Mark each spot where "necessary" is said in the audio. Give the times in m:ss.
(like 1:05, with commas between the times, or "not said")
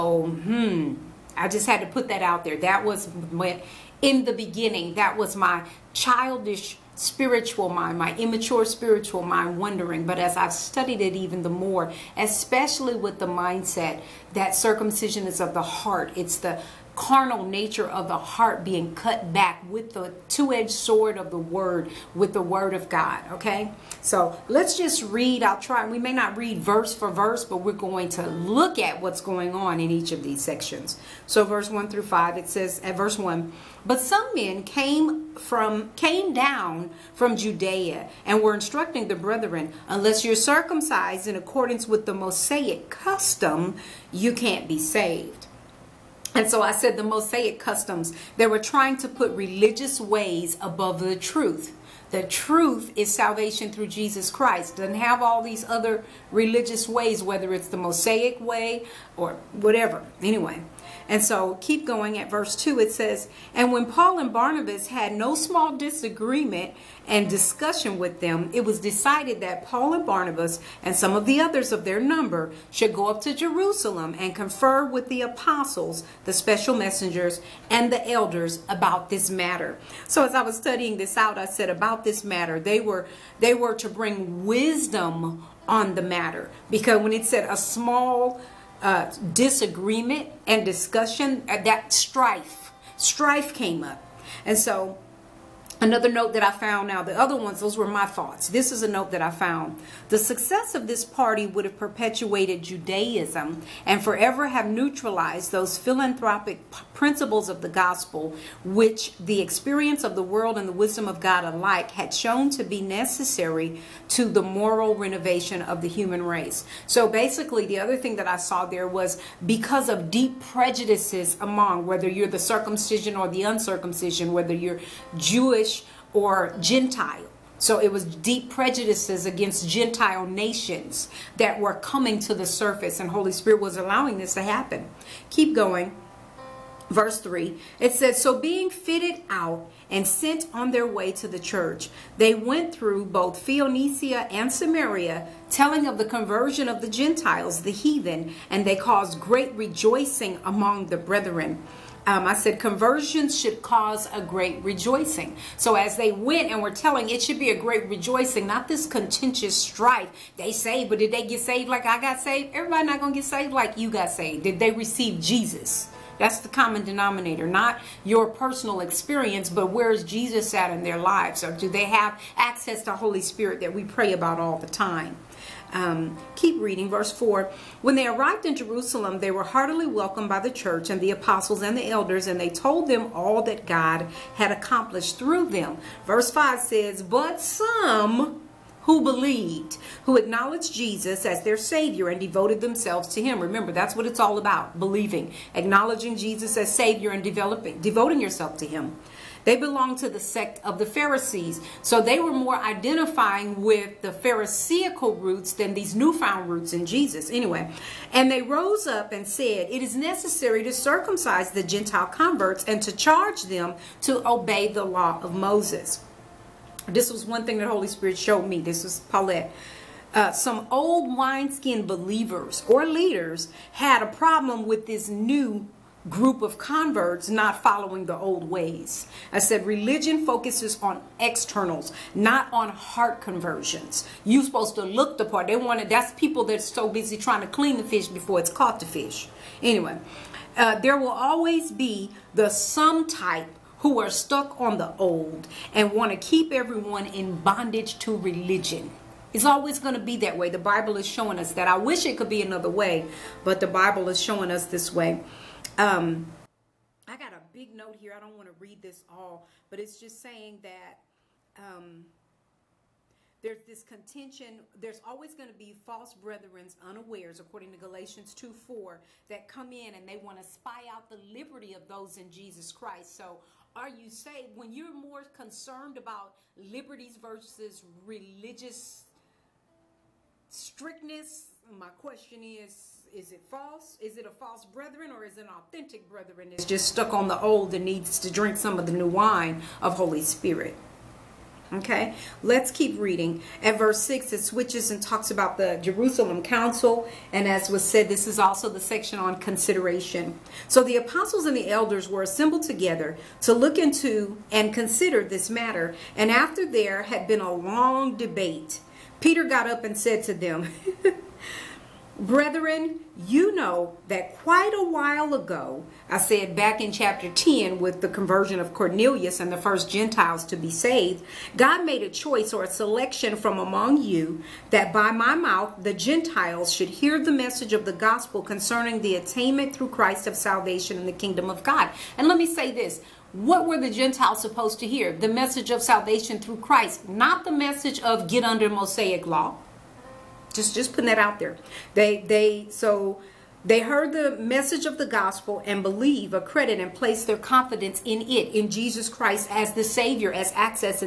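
1:52, 3:29.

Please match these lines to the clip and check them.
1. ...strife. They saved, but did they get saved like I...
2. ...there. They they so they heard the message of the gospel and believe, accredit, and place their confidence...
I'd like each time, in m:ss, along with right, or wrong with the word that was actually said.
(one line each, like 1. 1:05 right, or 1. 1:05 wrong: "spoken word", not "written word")
1. 2:39 right
2. 5:41 right.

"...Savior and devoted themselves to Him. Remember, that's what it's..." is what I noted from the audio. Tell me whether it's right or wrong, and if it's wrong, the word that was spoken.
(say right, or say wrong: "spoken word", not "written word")
right.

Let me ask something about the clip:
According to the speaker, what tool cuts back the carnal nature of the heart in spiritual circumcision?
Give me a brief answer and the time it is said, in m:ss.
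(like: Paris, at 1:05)
Two-edged sword, at 0:20.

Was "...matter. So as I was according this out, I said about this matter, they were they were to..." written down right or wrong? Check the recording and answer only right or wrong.
wrong.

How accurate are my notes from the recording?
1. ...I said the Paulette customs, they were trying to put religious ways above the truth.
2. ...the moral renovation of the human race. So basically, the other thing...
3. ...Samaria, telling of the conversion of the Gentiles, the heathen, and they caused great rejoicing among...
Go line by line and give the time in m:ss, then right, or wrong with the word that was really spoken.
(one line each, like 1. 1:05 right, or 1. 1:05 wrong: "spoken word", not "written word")
1. 0:46 wrong: "Mosaic", not "Paulette"
2. 1:54 right
3. 2:24 right.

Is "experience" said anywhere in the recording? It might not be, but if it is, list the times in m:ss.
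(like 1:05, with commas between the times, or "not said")
1:49, 2:48.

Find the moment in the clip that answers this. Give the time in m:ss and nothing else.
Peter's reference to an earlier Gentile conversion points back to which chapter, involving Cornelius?
5:16.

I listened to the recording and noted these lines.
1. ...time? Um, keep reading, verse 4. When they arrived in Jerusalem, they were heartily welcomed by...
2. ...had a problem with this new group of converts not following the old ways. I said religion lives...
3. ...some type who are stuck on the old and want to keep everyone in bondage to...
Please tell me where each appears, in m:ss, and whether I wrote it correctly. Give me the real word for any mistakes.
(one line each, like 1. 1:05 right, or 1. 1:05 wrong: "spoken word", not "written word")
1. 2:54 right
2. 3:43 wrong: "focuses", not "lives"
3. 4:02 right.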